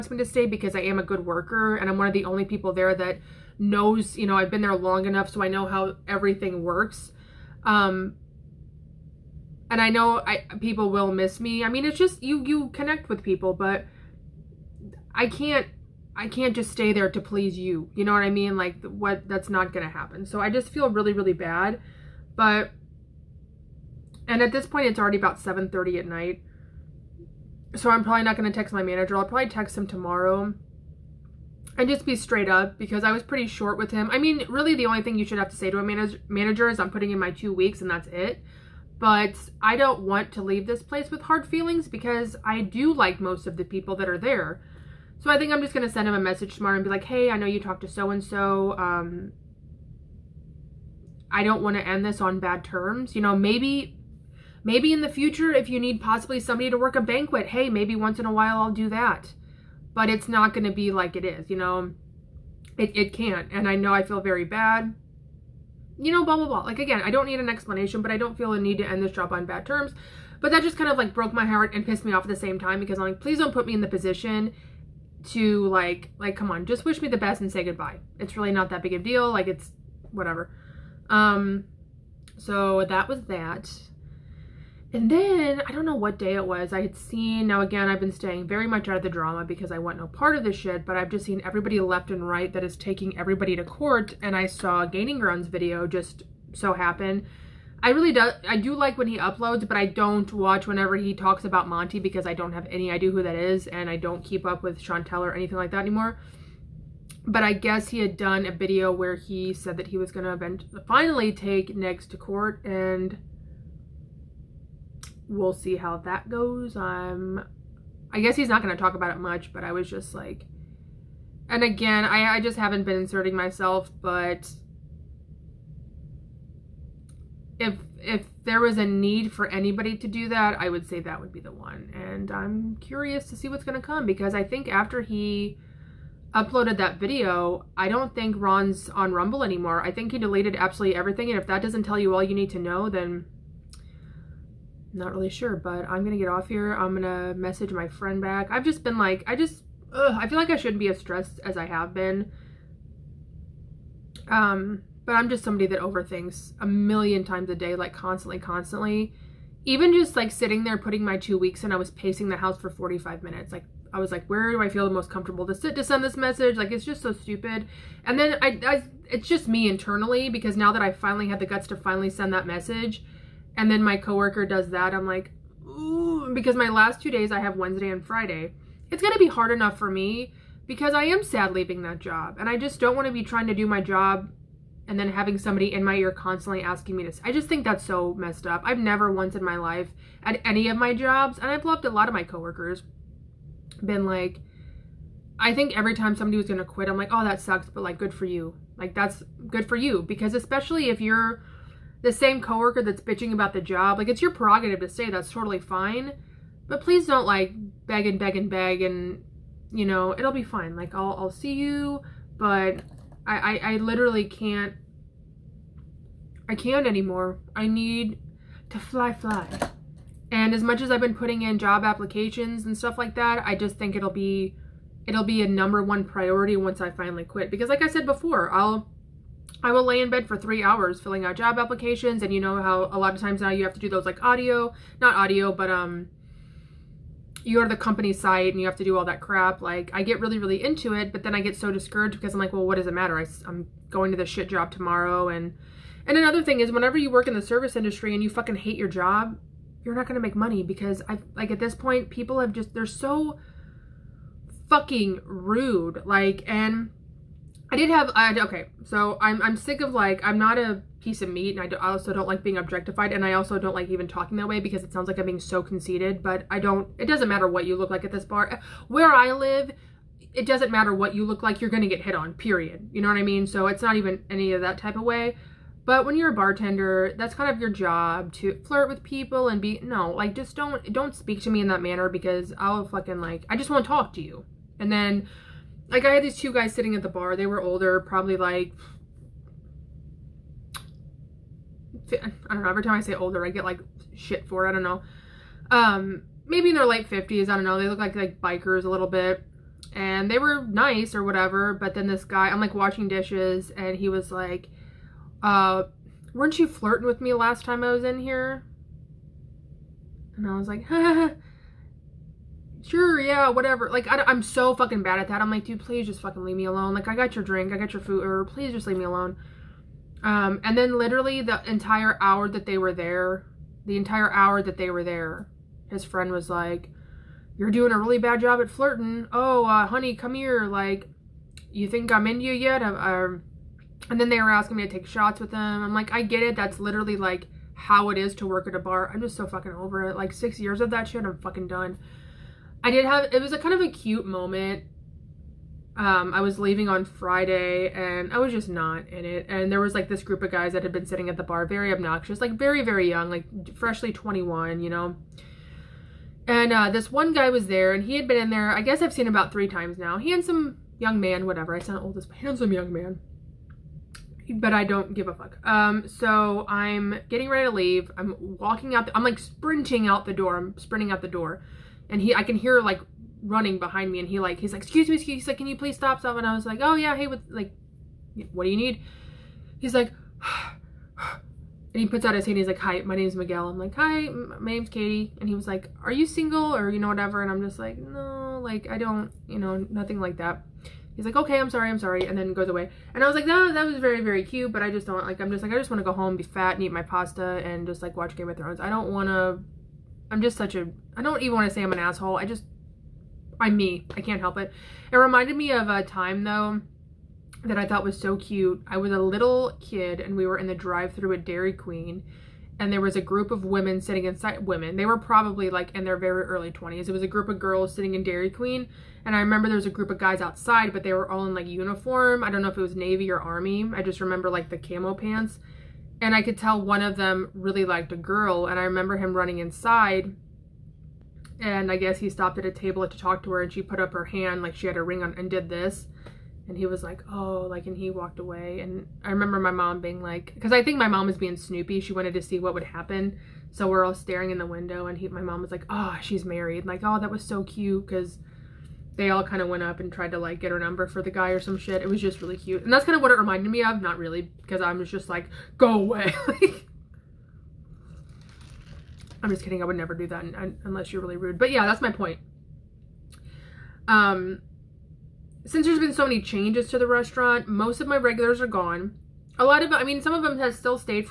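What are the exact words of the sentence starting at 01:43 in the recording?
And I don't keep up with Chantel or anything like that anymore.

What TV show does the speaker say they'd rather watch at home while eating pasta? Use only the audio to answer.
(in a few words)
Game of Thrones.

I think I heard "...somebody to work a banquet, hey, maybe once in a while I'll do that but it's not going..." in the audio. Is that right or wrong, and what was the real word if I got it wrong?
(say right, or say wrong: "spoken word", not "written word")
right.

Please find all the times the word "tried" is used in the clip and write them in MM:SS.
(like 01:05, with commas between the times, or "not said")
07:30.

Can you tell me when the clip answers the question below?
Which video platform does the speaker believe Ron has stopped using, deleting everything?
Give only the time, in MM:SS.
02:19.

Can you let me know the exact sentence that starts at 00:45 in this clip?
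So I think I'm just going to send him a message tomorrow and be like, hey, I know you talked to so-and-so.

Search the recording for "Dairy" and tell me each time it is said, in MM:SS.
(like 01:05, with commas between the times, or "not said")
06:51, 06:58.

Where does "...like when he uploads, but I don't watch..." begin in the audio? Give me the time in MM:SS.
01:38.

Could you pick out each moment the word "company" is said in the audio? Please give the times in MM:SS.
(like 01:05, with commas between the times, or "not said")
03:57.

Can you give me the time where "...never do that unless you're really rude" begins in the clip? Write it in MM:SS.
07:39.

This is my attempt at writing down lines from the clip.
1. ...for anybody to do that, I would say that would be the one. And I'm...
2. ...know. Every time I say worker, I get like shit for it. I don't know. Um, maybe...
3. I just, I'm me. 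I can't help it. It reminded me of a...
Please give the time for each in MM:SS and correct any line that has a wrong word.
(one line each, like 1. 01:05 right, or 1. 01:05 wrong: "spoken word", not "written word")
1. 02:09 right
2. 04:52 wrong: "older", not "worker"
3. 06:42 right.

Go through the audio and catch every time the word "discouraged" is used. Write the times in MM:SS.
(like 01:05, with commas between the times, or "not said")
04:01.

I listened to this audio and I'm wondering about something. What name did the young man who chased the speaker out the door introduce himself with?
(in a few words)
Miguel.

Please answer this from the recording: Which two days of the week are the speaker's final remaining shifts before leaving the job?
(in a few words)
Wednesday and Friday.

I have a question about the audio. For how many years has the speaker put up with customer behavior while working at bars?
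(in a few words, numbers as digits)
6.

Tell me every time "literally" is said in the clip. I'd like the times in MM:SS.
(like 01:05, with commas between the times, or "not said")
03:33, 05:20, 05:36.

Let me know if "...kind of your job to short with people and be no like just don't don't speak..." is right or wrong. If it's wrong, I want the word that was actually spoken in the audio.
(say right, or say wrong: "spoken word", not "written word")
wrong: "flirt", not "short".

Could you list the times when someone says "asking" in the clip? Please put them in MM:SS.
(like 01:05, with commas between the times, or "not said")
03:06, 05:34.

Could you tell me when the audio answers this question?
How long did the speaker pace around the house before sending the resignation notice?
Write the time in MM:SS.
02:42.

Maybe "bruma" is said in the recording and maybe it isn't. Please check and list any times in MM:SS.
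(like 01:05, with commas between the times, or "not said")
not said.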